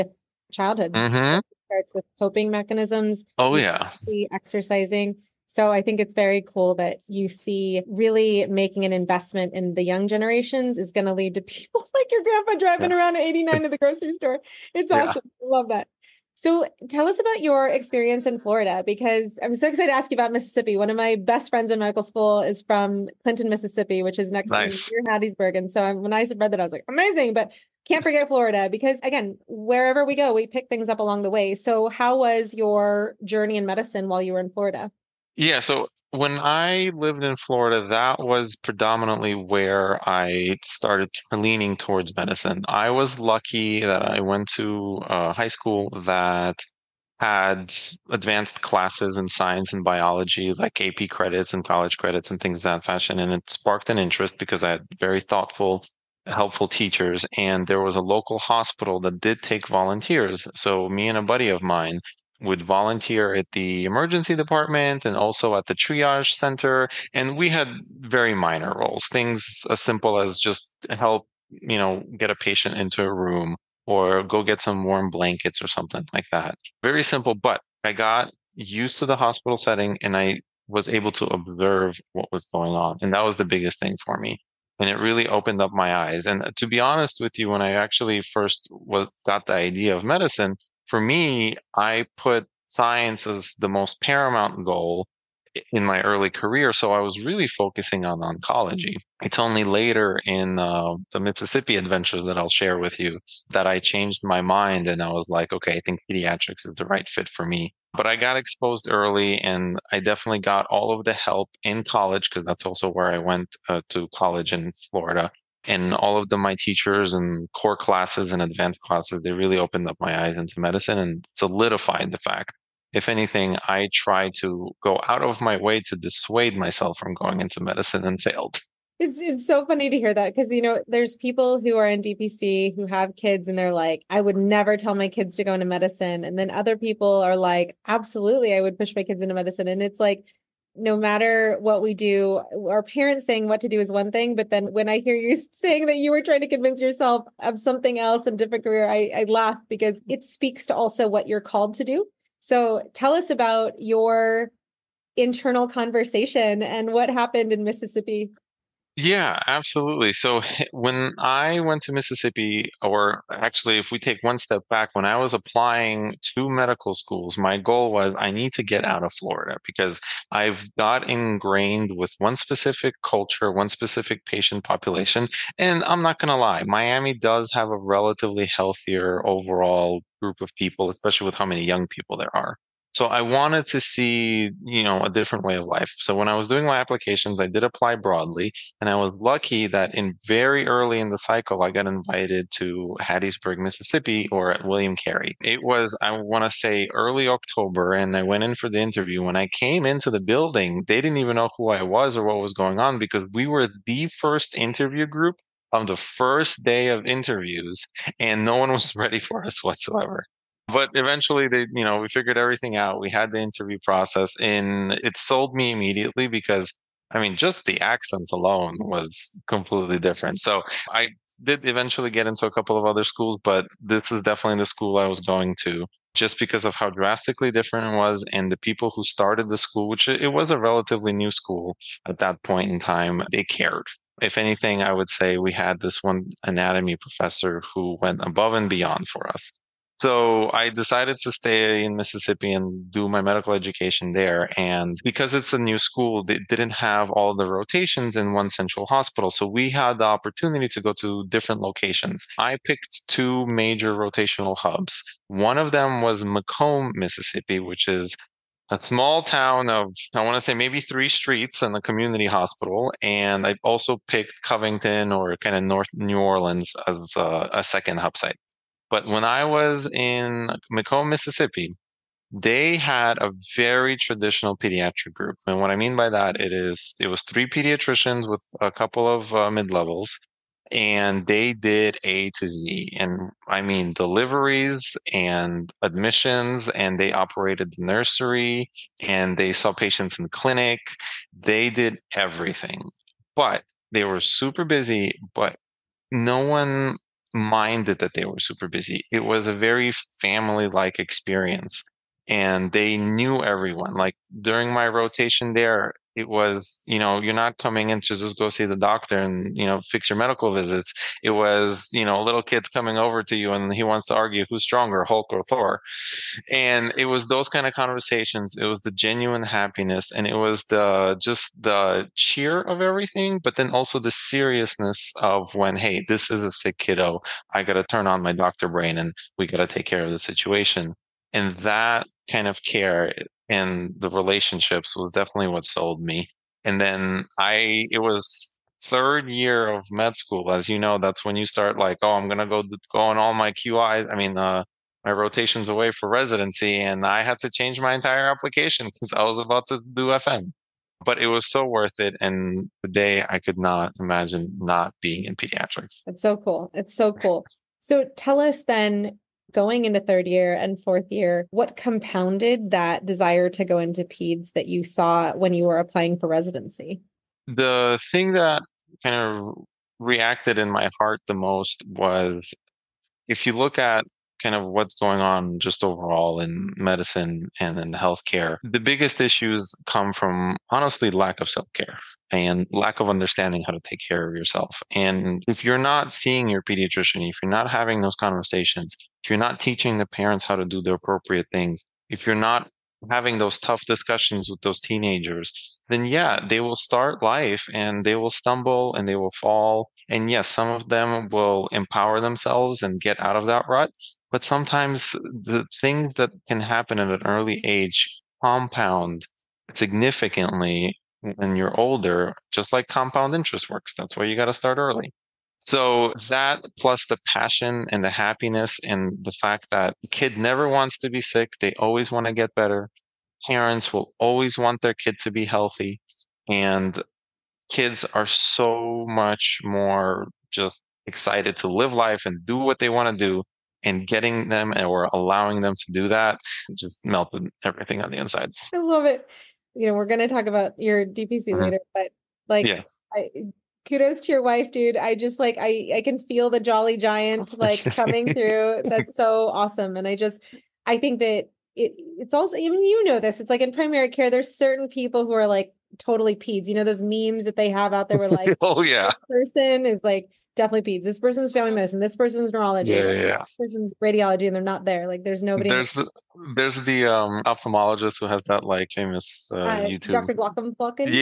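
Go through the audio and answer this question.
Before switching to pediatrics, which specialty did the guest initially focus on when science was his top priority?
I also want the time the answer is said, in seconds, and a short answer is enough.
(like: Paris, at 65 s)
Oncology, at 98 s.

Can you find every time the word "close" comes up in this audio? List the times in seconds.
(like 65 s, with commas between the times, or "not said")
not said.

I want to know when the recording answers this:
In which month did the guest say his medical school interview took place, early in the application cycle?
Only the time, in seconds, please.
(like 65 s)
196 s.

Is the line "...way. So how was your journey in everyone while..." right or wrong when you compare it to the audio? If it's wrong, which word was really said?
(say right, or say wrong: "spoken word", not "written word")
wrong: "medicine", not "everyone".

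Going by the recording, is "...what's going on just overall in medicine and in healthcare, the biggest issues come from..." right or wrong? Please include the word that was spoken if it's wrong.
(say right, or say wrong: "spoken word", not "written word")
right.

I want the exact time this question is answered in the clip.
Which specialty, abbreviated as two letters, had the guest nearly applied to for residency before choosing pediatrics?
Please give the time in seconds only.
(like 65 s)
350 s.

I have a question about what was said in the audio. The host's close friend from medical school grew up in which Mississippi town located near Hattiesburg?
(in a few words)
Clinton.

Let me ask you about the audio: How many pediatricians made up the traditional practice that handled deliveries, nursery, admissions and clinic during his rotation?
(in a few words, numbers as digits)
3.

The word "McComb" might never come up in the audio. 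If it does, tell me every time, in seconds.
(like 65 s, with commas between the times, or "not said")
256 s, 270 s.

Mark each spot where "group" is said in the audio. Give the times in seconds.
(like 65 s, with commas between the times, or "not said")
180 s, 205 s, 275 s.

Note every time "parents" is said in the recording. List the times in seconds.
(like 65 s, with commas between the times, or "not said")
142 s, 390 s, 423 s.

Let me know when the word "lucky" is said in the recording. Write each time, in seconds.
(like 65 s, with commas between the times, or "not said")
43 s, 189 s.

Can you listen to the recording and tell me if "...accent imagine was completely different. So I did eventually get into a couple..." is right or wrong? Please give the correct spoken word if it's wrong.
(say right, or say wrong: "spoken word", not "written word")
wrong: "alone", not "imagine".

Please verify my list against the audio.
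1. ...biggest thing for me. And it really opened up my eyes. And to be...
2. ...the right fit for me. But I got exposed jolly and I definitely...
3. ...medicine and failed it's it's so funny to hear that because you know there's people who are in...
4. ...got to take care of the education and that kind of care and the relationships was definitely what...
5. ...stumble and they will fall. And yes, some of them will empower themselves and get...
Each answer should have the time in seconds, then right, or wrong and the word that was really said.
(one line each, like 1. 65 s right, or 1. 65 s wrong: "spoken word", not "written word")
1. 83 s right
2. 106 s wrong: "early", not "jolly"
3. 127 s right
4. 329 s wrong: "situation", not "education"
5. 398 s right.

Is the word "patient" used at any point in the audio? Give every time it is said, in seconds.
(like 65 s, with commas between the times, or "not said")
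72 s, 174 s, 289 s.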